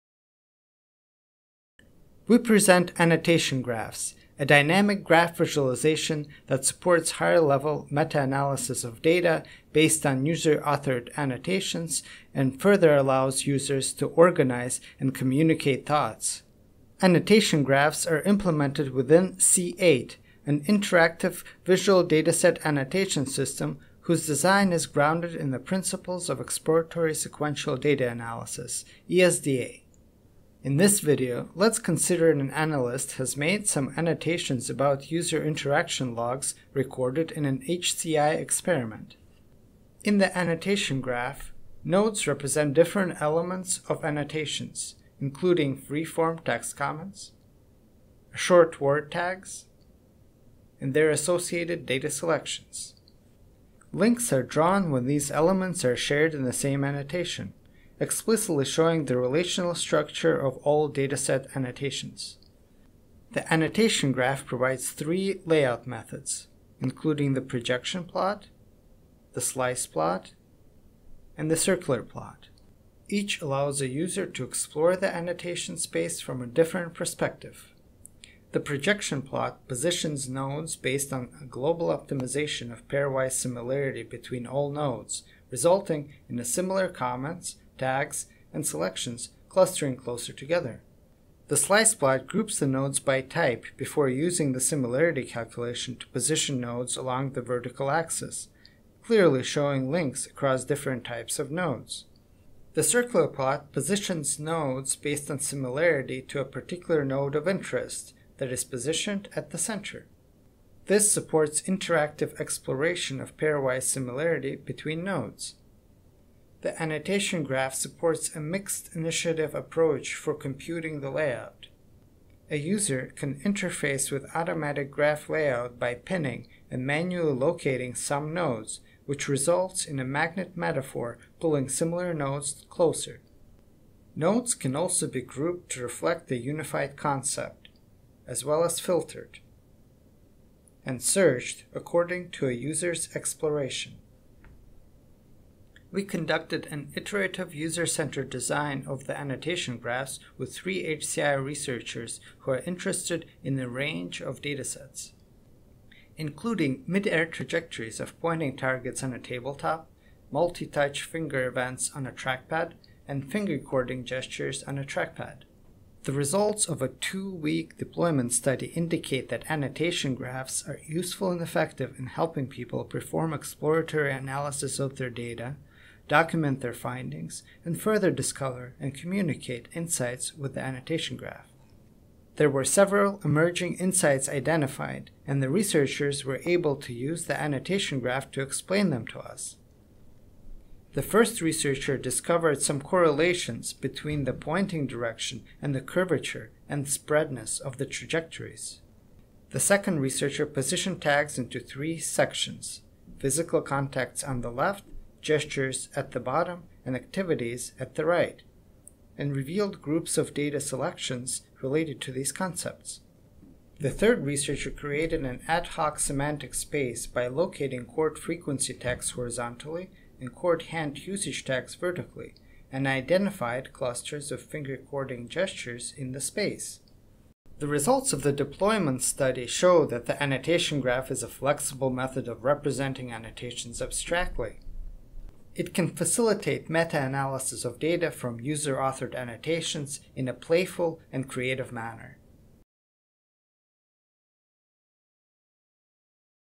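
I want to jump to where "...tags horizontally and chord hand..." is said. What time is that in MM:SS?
03:38.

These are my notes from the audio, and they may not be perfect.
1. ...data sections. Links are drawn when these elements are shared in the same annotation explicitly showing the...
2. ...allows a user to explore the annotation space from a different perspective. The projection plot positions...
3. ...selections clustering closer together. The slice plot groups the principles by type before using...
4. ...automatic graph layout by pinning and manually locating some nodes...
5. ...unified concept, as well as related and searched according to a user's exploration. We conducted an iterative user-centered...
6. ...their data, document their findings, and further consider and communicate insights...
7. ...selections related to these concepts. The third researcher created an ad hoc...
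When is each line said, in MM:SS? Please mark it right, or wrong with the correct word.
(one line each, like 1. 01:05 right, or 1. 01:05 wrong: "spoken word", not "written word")
1. 00:51 wrong: "selections", not "sections"
2. 01:13 right
3. 01:28 wrong: "nodes", not "principles"
4. 02:04 right
5. 02:16 wrong: "filtered", not "related"
6. 02:54 wrong: "discover", not "consider"
7. 03:30 right.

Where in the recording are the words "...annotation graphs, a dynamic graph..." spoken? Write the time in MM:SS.
00:02.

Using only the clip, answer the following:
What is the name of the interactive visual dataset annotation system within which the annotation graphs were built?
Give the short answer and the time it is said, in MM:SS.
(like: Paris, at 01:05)
C8, at 00:19.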